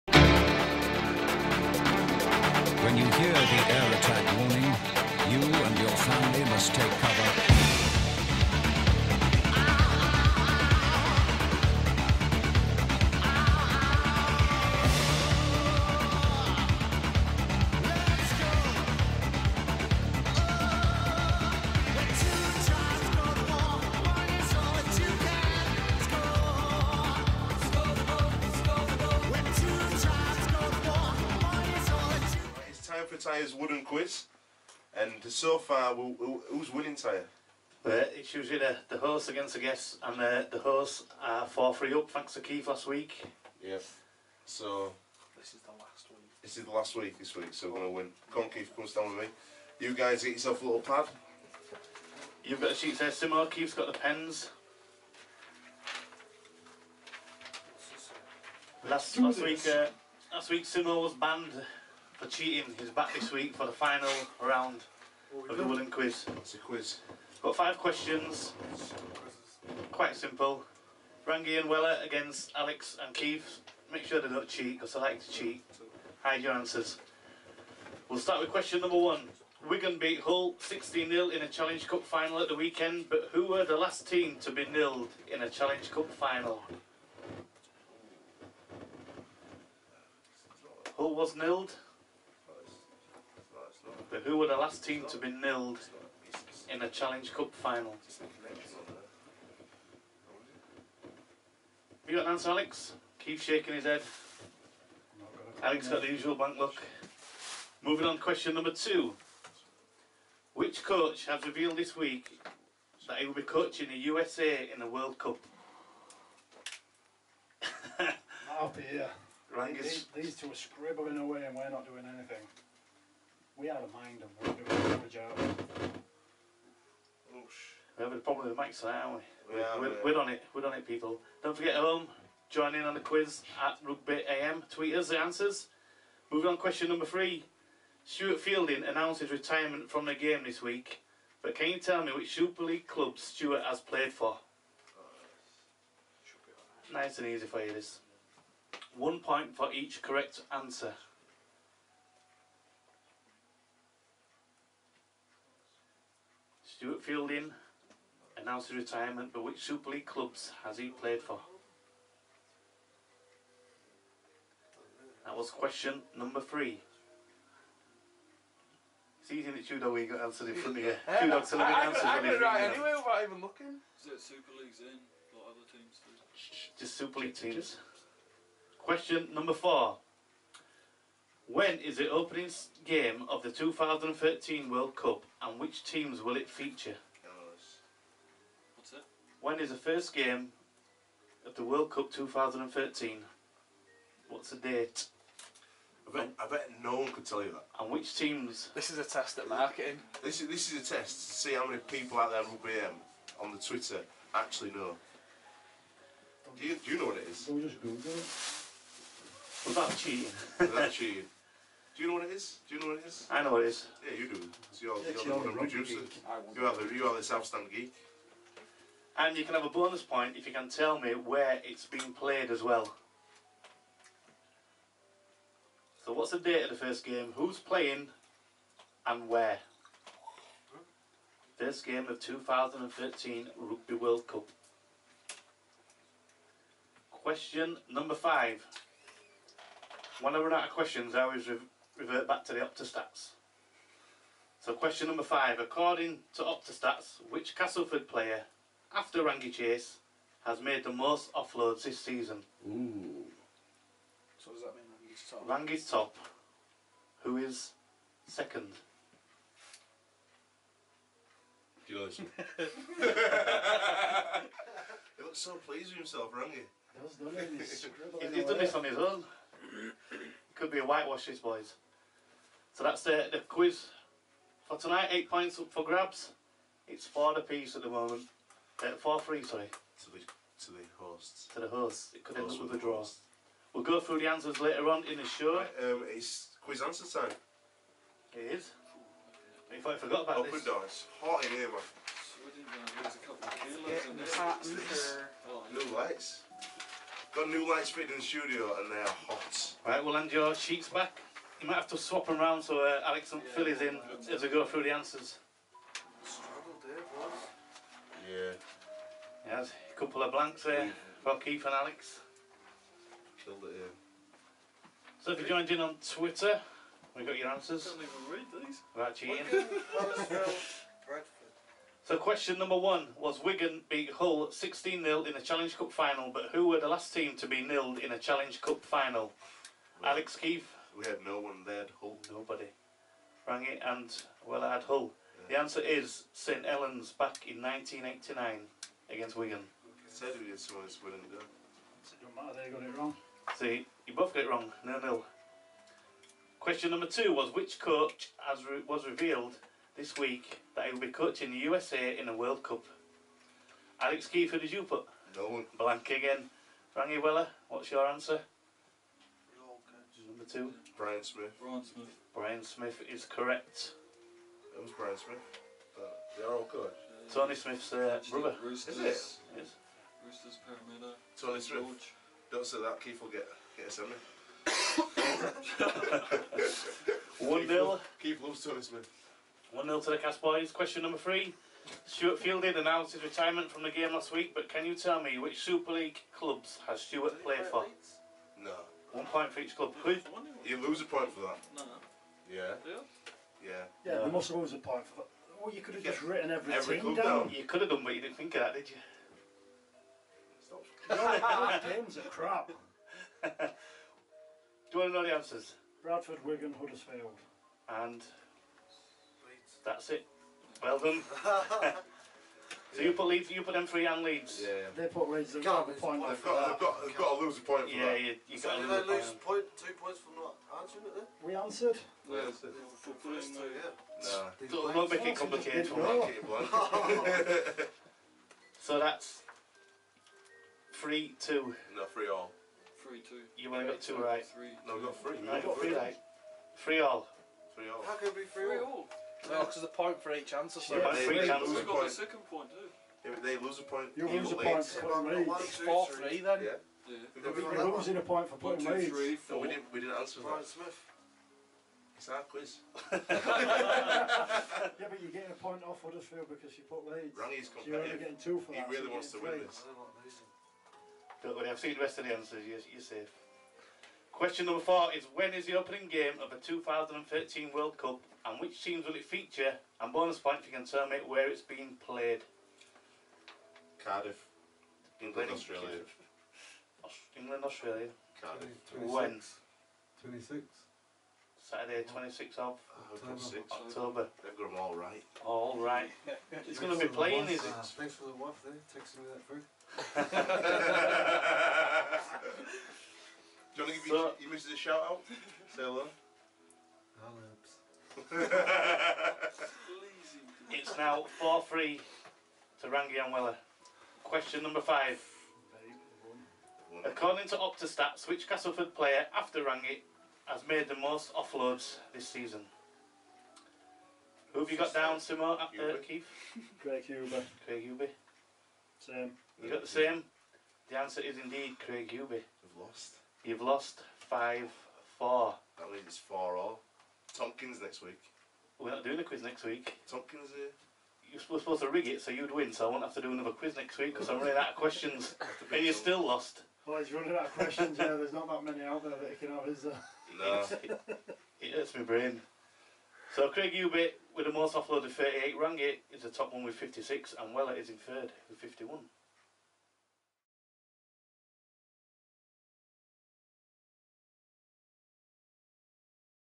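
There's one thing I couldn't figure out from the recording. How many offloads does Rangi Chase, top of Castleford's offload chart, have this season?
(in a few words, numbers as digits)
56.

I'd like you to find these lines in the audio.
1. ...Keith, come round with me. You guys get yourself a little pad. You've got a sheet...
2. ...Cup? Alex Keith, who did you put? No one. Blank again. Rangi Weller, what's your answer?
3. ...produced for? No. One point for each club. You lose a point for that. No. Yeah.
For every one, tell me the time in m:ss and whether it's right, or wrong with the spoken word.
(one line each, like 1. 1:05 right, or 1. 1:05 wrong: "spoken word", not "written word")
1. 0:48 wrong: "stand", not "round"
2. 5:52 right
3. 6:27 wrong: "played", not "produced".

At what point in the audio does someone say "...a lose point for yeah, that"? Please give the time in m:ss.
6:57.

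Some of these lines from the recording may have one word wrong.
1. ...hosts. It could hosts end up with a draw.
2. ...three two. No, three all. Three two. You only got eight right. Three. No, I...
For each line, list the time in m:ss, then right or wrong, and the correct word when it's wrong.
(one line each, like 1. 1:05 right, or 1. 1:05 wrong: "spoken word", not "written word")
1. 4:41 right
2. 7:10 wrong: "two", not "eight".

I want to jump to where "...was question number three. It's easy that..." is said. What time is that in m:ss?
2:45.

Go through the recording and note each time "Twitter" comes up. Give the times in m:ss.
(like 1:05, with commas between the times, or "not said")
3:23, 5:15.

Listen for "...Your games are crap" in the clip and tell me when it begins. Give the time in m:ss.
6:41.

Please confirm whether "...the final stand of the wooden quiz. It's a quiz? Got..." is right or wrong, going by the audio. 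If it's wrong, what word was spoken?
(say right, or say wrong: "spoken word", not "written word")
wrong: "round", not "stand".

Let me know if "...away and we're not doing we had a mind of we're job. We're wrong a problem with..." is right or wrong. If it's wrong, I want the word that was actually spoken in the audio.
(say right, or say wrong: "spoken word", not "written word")
wrong: "having", not "wrong".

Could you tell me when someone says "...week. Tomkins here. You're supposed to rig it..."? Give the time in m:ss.
8:49.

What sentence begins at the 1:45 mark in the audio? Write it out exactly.
Alex got the usual blank look.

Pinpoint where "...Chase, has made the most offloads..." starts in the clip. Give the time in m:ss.
4:09.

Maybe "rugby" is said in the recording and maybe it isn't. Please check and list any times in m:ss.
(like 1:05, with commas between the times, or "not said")
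2:13, 3:22, 3:53.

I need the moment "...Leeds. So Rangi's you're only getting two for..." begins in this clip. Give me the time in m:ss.
7:37.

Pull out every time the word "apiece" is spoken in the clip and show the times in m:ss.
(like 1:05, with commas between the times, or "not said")
4:37.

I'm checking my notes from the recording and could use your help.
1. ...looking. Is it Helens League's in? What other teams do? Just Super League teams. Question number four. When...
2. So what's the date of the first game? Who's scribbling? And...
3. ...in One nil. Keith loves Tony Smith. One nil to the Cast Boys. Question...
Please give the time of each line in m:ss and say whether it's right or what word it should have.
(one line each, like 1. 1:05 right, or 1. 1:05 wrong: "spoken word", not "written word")
1. 2:53 wrong: "Super", not "Helens"
2. 3:46 wrong: "playing", not "scribbling"
3. 6:17 right.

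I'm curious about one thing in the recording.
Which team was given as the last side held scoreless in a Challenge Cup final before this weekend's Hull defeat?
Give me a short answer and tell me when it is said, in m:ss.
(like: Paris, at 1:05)
St Helens, at 5:36.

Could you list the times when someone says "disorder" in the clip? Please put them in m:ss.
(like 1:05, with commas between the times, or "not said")
not said.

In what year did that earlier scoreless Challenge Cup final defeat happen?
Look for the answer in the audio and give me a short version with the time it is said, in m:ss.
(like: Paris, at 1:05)
1989, at 5:37.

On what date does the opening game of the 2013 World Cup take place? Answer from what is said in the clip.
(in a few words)
Saturday 26th October.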